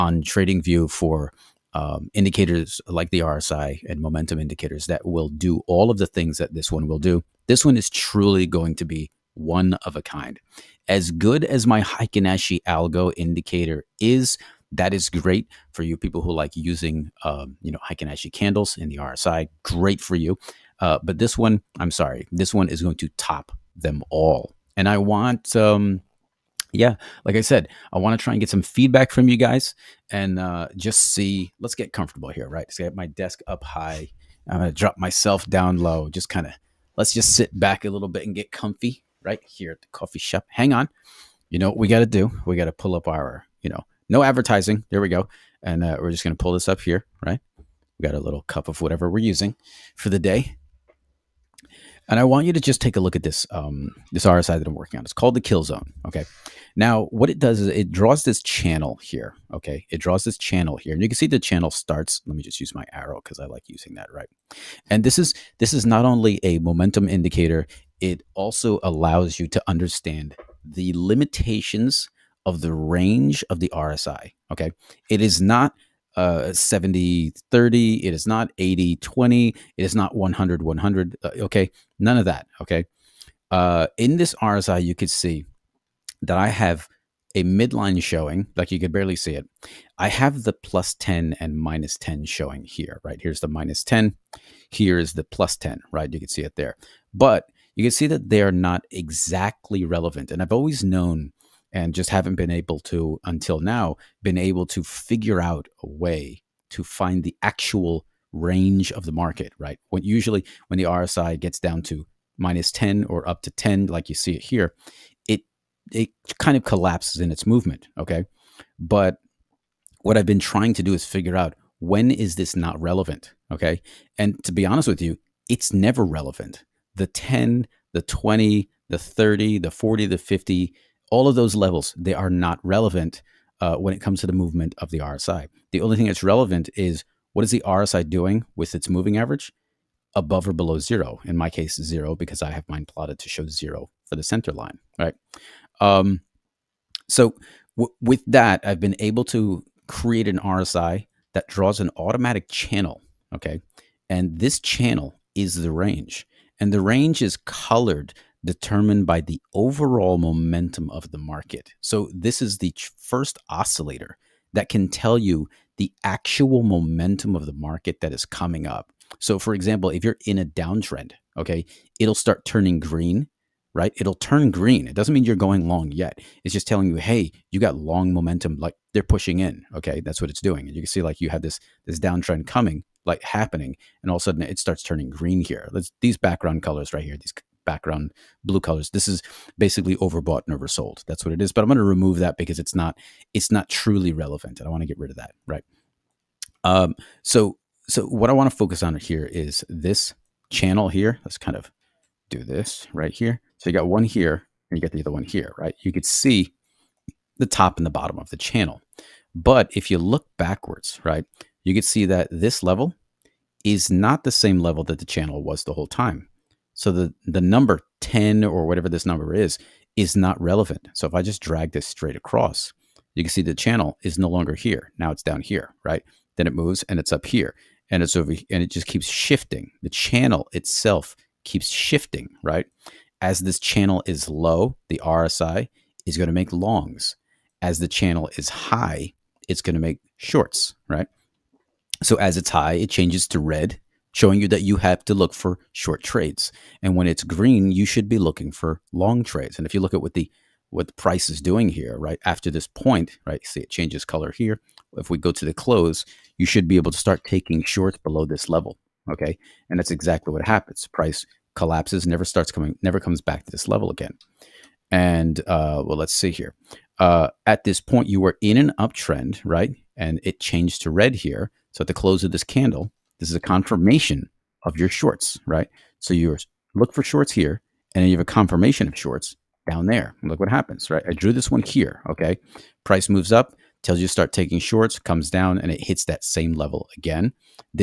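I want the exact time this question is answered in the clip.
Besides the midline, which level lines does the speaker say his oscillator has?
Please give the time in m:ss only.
1:30.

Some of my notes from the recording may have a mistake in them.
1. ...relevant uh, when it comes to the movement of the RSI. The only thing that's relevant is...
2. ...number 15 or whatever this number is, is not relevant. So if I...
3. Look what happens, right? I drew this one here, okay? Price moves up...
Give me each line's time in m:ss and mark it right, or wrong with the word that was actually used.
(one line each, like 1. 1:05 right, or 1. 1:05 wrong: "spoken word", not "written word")
1. 2:12 right
2. 3:37 wrong: "10", not "15"
3. 4:40 right.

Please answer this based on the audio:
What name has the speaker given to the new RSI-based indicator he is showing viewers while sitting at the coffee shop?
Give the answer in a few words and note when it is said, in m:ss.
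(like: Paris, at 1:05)
Kill zone, at 0:55.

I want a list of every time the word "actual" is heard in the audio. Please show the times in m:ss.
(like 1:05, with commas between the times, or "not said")
1:47, 2:46.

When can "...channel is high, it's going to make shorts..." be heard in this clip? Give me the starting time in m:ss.
3:57.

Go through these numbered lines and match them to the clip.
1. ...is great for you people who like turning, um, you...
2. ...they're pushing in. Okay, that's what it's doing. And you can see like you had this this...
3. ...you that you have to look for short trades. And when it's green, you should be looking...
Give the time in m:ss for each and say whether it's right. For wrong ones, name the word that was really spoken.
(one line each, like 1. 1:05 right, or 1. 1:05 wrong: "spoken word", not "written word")
1. 0:14 wrong: "using", not "turning"
2. 2:58 right
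3. 4:04 right.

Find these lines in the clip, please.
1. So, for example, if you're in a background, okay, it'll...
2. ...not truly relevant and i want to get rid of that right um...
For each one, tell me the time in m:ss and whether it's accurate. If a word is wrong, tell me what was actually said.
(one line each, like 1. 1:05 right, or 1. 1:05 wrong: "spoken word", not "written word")
1. 2:49 wrong: "downtrend", not "background"
2. 3:13 right.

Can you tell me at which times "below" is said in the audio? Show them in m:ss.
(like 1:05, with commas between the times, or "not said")
2:20, 4:17.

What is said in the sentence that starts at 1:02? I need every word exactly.
Let me just use my arrow because I like using that, right?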